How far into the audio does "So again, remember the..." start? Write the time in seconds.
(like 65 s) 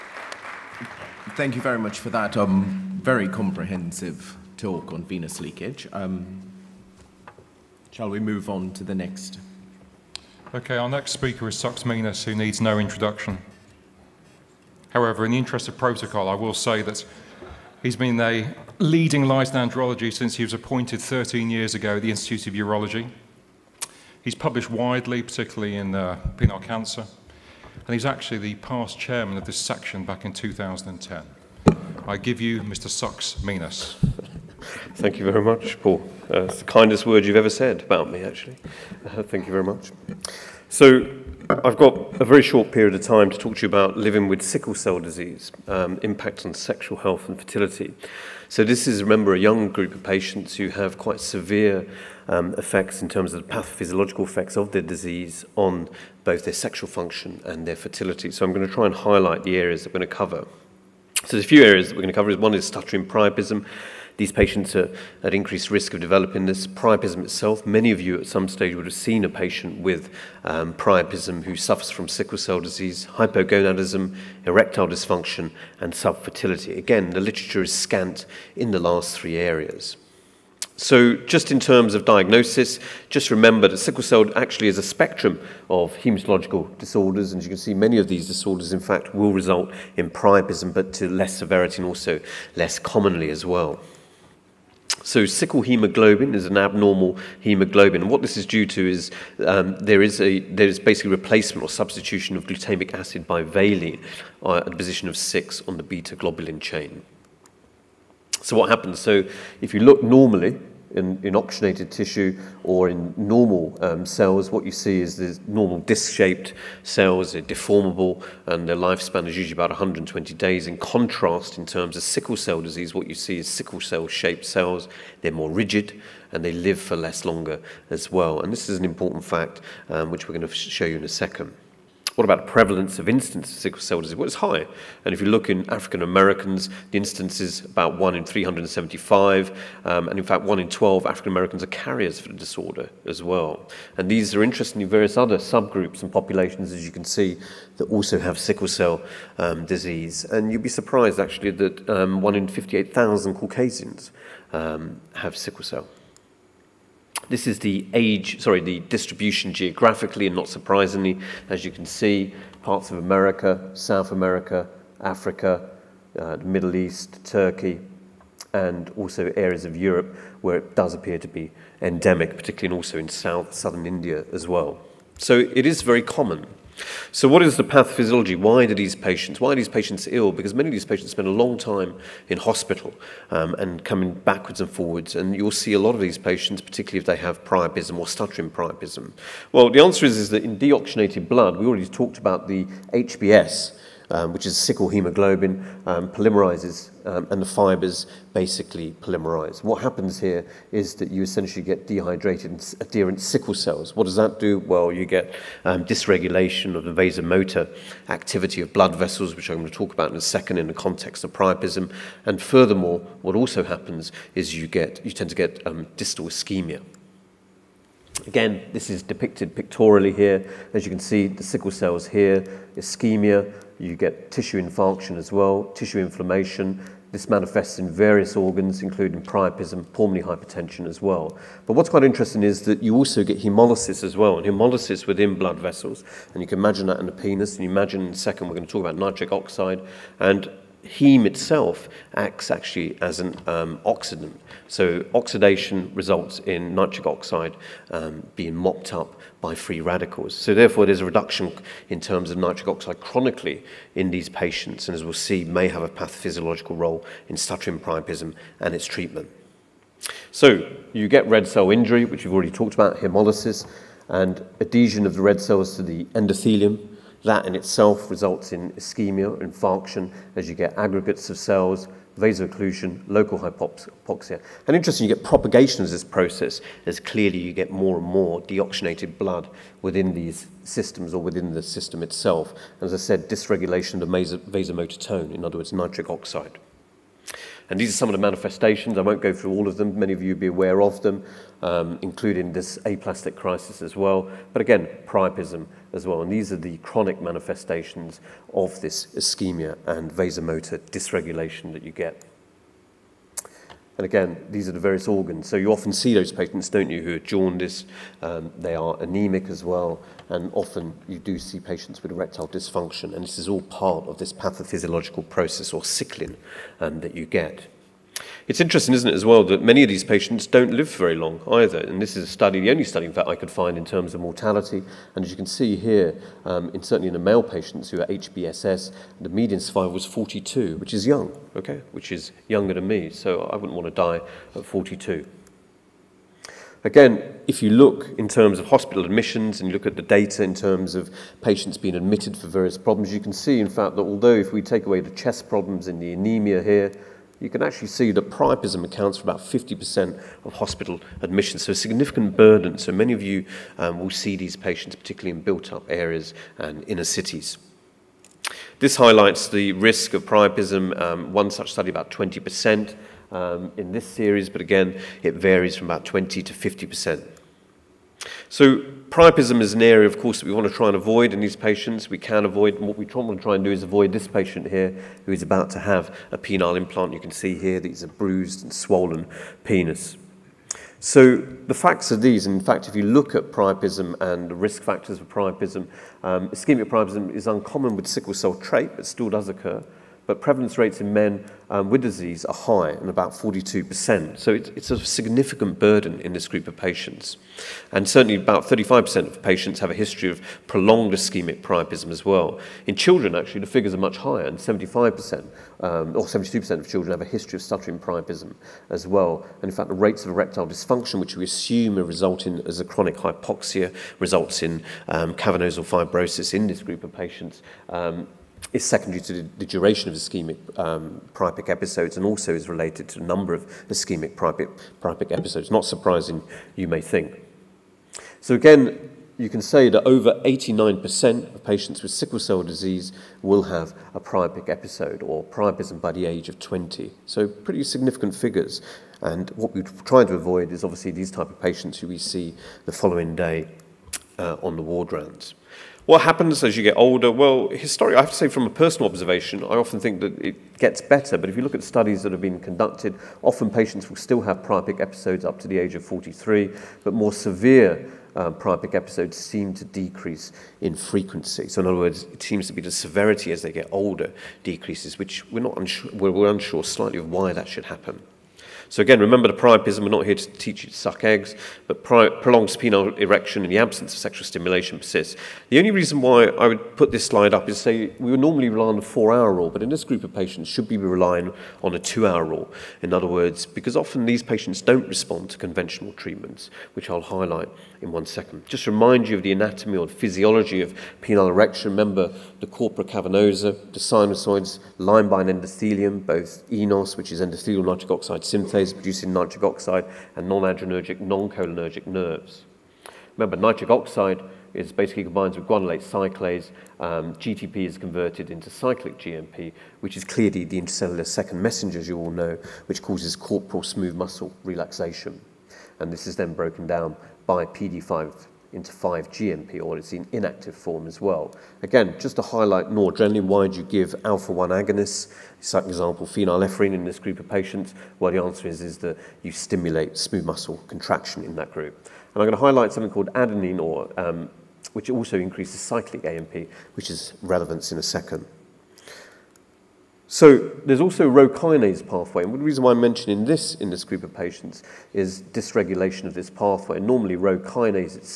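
468 s.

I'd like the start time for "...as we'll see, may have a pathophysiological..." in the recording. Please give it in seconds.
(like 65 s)
254 s.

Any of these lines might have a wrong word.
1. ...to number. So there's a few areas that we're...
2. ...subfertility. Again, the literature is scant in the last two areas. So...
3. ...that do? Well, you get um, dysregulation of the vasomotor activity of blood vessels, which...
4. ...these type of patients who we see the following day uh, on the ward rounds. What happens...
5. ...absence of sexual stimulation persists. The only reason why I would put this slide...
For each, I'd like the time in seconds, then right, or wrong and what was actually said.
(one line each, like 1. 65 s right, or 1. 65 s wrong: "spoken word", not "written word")
1. 60 s wrong: "cover", not "number"
2. 75 s wrong: "three", not "two"
3. 204 s right
4. 441 s right
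5. 473 s right.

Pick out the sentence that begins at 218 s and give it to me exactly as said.
Again, this is depicted pictorially here.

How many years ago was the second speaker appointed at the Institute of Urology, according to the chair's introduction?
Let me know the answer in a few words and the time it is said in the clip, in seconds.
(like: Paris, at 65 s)
13, at 21 s.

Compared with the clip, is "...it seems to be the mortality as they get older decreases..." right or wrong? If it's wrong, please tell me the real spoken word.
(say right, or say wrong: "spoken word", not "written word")
wrong: "severity", not "mortality".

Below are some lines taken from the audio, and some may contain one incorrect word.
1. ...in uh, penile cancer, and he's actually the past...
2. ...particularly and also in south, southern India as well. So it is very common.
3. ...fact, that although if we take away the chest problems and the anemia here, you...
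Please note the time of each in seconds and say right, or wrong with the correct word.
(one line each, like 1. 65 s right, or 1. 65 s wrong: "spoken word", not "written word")
1. 25 s right
2. 172 s right
3. 343 s right.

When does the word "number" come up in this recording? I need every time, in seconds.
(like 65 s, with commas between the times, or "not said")
423 s.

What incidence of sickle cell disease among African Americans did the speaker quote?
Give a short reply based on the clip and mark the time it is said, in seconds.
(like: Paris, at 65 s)
1 in 375, at 137 s.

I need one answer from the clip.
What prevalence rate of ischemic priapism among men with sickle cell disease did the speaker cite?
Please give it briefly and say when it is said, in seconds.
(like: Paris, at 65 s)
42%, at 393 s.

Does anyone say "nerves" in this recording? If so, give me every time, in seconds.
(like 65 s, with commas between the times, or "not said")
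502 s.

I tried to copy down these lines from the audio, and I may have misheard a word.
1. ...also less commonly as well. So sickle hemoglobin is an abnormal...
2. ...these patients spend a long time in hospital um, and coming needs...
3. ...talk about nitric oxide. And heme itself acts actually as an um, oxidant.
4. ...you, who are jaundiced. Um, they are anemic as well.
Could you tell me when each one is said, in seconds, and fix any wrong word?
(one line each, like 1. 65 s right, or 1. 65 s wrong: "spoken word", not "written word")
1. 91 s right
2. 180 s wrong: "backwards", not "needs"
3. 238 s right
4. 306 s right.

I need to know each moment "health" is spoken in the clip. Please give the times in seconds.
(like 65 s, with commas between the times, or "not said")
46 s.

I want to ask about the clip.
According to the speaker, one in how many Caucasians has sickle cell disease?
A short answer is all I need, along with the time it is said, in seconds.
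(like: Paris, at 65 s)
58,000, at 152 s.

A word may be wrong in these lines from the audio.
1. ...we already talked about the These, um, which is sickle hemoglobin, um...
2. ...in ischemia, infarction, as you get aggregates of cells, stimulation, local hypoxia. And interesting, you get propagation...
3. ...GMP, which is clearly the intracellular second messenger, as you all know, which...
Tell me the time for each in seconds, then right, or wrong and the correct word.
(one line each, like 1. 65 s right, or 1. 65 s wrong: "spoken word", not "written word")
1. 191 s wrong: "HBS", not "These"
2. 268 s wrong: "vasoocclusion", not "stimulation"
3. 509 s right.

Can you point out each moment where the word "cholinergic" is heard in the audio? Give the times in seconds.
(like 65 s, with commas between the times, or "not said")
501 s.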